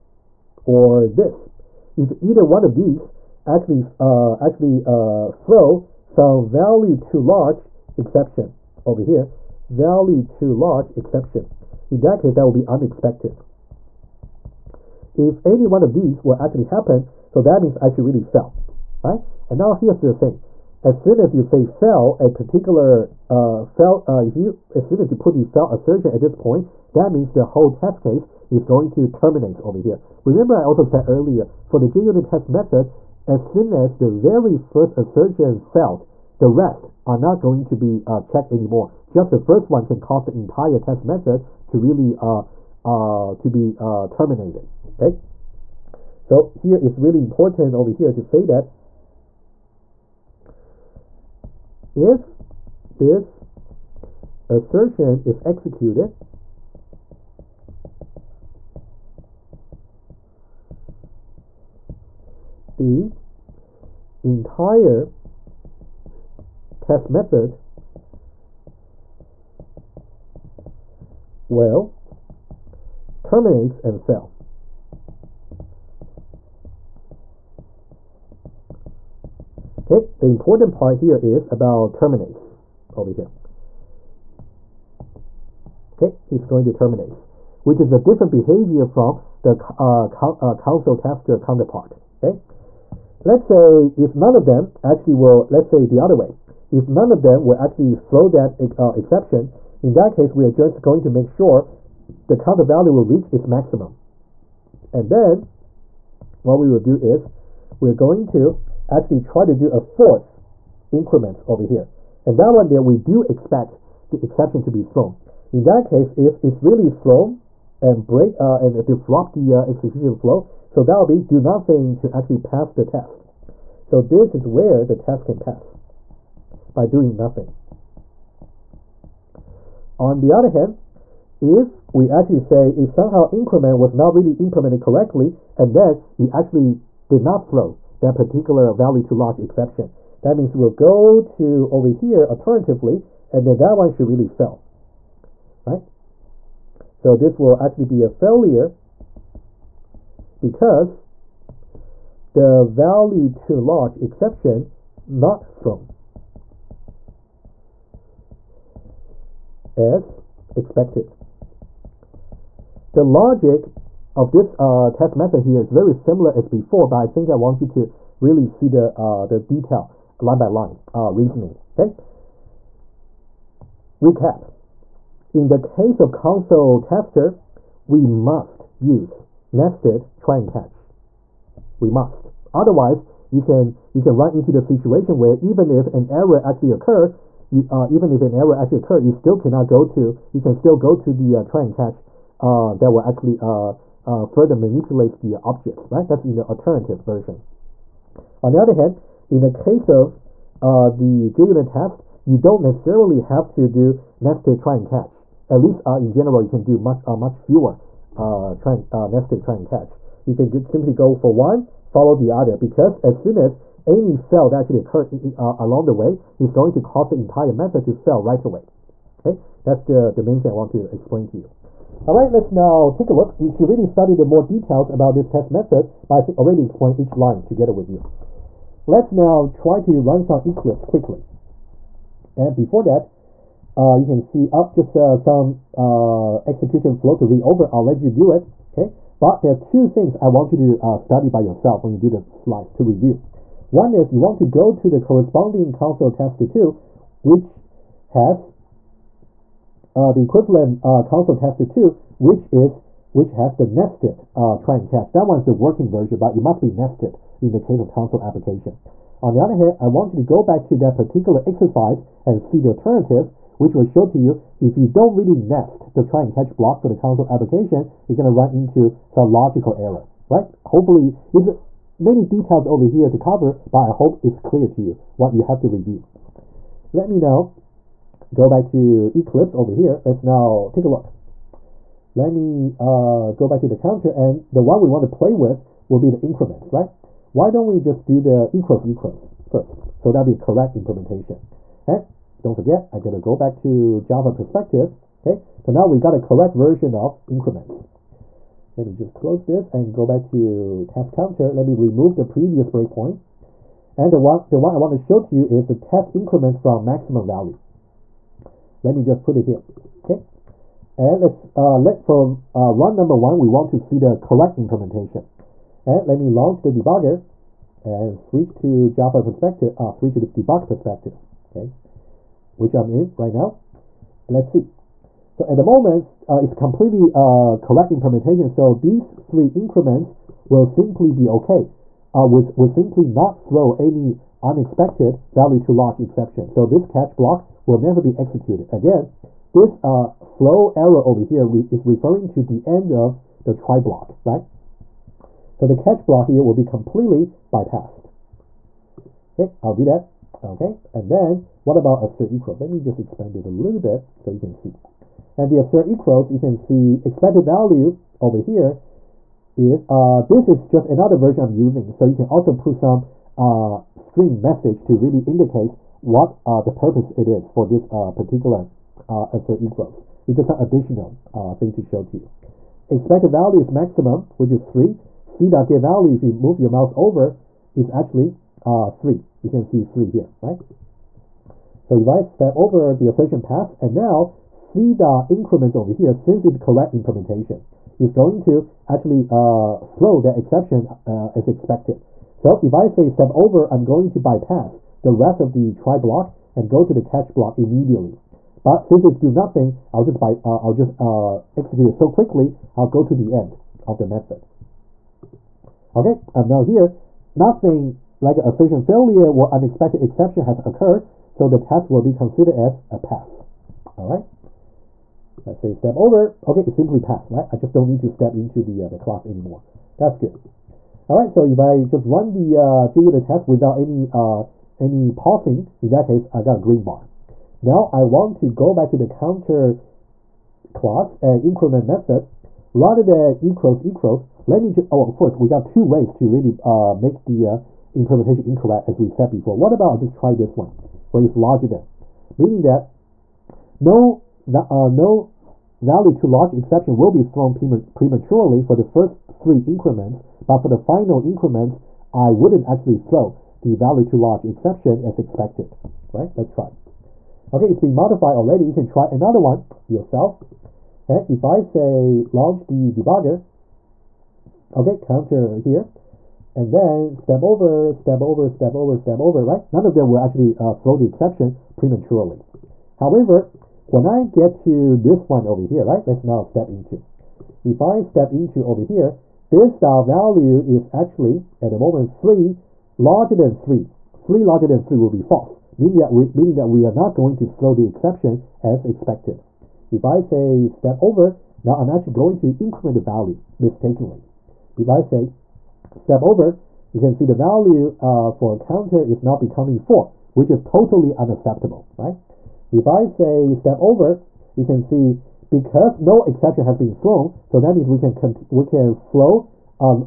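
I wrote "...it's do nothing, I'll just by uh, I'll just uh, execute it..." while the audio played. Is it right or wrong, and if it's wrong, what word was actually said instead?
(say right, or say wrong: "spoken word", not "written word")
right.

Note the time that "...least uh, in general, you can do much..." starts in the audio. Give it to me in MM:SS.
03:25.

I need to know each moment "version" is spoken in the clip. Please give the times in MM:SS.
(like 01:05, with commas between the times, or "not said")
03:17, 04:15, 04:56, 06:01.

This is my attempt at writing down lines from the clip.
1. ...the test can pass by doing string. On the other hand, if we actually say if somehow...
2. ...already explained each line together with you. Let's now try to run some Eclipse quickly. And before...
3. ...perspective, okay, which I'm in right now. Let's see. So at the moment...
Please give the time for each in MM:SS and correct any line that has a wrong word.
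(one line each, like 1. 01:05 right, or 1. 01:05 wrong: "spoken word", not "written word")
1. 02:04 wrong: "nothing", not "string"
2. 03:46 right
3. 05:20 right.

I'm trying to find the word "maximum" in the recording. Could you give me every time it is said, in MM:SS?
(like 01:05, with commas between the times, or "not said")
01:43, 05:06, 06:13.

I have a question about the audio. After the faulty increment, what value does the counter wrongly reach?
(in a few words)
4.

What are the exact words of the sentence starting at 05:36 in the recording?
So this catch block will never be executed.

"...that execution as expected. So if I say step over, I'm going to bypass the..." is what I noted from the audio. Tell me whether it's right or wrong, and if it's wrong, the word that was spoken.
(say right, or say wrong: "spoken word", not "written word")
wrong: "exception", not "execution".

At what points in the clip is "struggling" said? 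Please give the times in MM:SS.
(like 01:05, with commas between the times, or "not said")
not said.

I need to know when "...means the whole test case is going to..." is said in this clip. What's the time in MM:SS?
00:27.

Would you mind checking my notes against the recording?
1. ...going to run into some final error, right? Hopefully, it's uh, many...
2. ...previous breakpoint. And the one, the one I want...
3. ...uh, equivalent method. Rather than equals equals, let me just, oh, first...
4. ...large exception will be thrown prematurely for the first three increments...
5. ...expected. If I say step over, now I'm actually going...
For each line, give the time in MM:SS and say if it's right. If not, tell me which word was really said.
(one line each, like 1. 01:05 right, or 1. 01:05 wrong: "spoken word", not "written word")
1. 04:28 wrong: "logical", not "final"
2. 05:02 right
3. 07:11 wrong: "increment", not "equivalent"
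4. 07:26 right
5. 08:08 right.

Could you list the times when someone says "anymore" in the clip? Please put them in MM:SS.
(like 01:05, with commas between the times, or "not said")
00:38, 06:59.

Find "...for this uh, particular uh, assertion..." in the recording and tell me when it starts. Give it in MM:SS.
06:07.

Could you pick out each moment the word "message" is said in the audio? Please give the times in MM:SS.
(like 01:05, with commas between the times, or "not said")
06:04.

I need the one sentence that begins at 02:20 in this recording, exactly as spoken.
That means we'll go to over here alternatively, and then that one should really fail, right?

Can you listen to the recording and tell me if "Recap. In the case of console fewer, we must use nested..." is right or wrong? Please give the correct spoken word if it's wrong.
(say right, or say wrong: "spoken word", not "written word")
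wrong: "tester", not "fewer".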